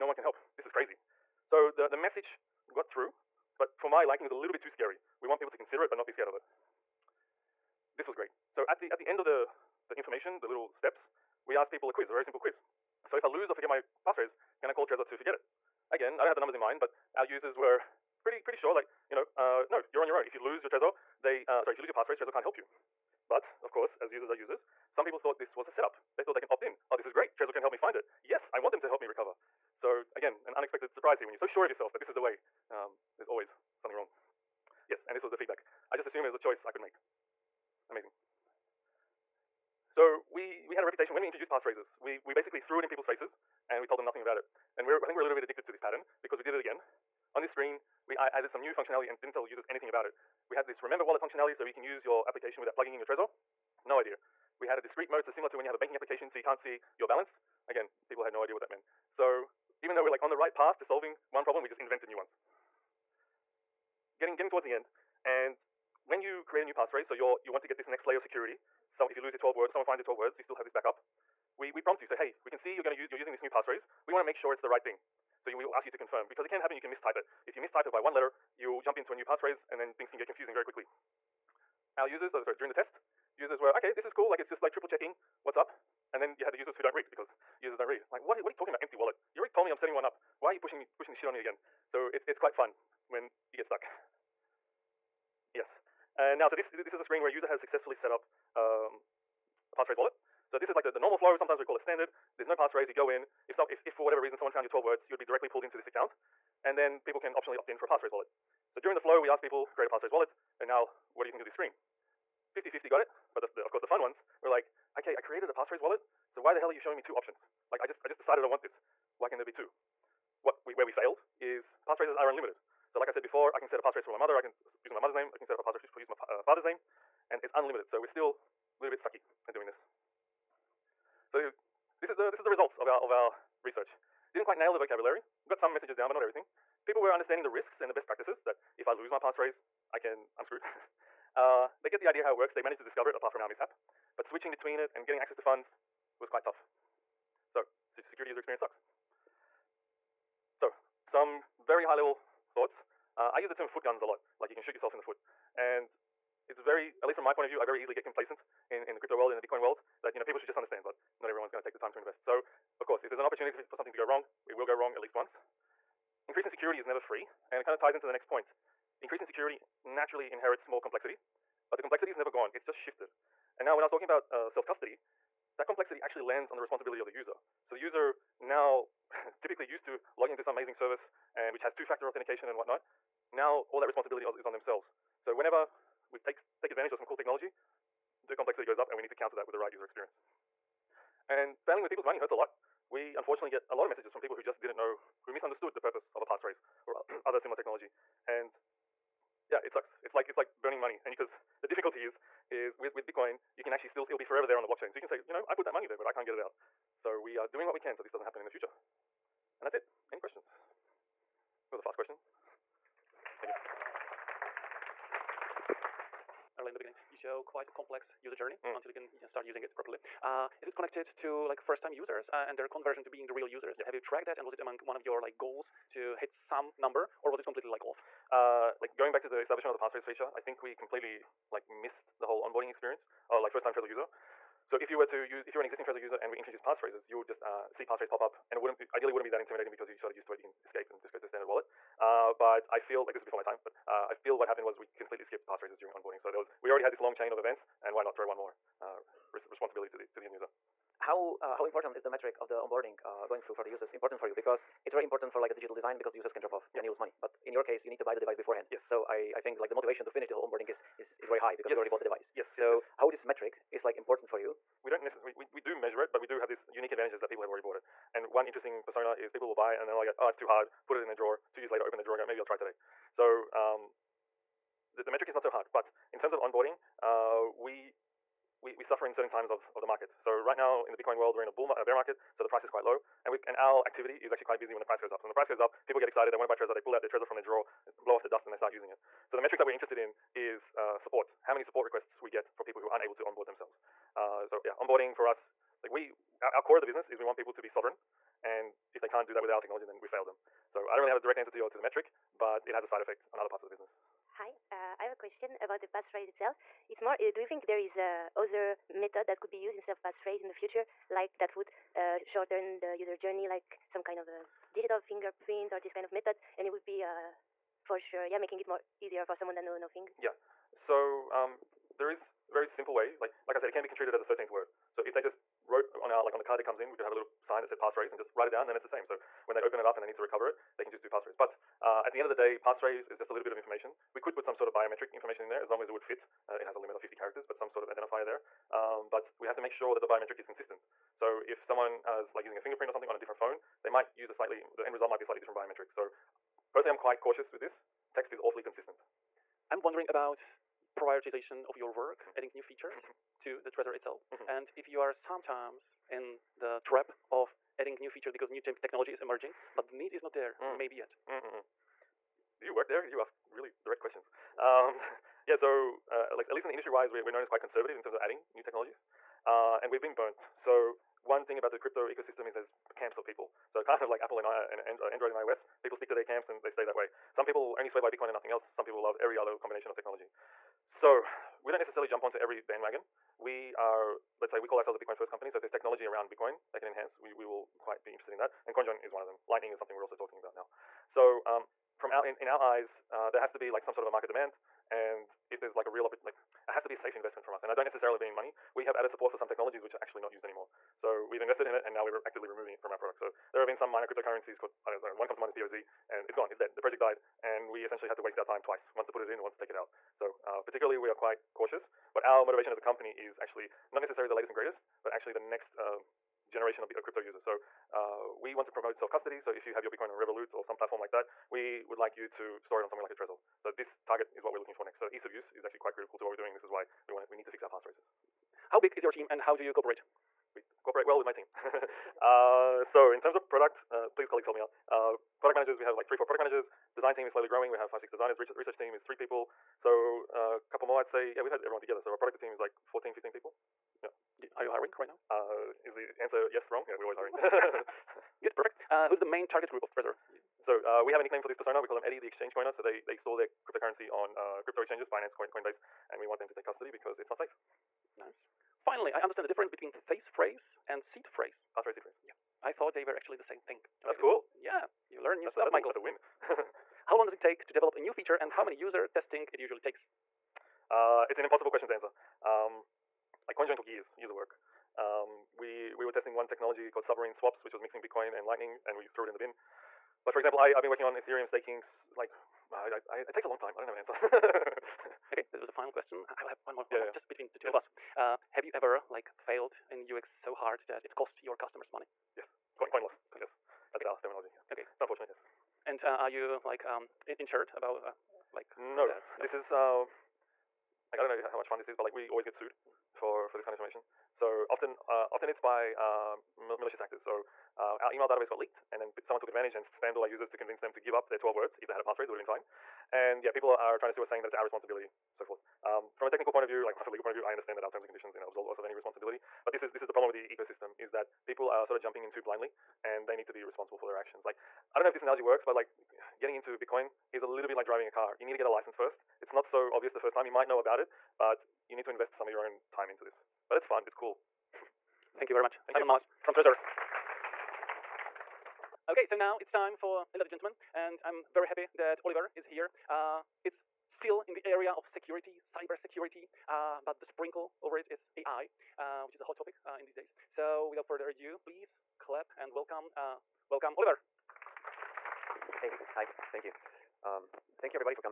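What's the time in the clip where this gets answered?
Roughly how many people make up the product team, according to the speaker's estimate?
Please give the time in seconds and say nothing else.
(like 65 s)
442 s.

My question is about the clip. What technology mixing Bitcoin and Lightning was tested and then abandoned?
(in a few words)
submarine swaps.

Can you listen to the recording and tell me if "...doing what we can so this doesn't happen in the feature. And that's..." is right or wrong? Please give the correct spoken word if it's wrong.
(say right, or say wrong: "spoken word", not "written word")
wrong: "future", not "feature".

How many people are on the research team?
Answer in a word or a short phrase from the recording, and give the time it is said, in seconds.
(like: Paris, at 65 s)
3, at 439 s.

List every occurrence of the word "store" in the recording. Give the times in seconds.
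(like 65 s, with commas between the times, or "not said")
422 s, 453 s.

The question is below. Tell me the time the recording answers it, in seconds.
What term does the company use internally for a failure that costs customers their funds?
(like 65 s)
492 s.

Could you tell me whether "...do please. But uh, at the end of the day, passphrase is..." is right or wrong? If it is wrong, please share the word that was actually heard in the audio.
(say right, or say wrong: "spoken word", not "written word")
wrong: "passphrase", not "please".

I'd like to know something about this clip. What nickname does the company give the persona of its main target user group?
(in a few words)
Eddie, the exchange coiner.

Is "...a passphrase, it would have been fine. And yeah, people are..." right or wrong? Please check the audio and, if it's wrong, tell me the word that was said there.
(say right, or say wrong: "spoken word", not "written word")
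right.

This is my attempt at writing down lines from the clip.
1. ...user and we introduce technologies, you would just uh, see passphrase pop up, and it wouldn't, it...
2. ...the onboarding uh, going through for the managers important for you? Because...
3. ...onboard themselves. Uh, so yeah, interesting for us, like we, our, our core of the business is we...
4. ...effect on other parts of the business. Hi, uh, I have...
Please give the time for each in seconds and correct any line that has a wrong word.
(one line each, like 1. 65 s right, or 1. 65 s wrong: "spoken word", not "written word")
1. 235 s wrong: "passphrases", not "technologies"
2. 252 s wrong: "users", not "managers"
3. 293 s wrong: "onboarding", not "interesting"
4. 303 s right.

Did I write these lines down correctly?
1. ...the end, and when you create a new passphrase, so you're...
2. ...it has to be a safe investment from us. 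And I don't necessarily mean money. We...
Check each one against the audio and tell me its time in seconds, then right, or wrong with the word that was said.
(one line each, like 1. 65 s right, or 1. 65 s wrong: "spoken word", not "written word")
1. 64 s right
2. 396 s right.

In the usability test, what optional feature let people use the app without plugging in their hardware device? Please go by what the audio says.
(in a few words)
remember wallet.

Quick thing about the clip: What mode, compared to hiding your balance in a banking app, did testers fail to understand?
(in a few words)
discrete mode.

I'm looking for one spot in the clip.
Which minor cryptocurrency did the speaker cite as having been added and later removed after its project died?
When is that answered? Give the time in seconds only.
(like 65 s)
405 s.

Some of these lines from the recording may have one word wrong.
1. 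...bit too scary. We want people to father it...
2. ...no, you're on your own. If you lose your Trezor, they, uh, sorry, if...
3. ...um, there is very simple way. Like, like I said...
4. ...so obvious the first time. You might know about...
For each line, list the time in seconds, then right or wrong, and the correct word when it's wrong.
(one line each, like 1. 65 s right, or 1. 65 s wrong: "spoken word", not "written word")
1. 4 s wrong: "consider", not "father"
2. 19 s right
3. 321 s right
4. 529 s right.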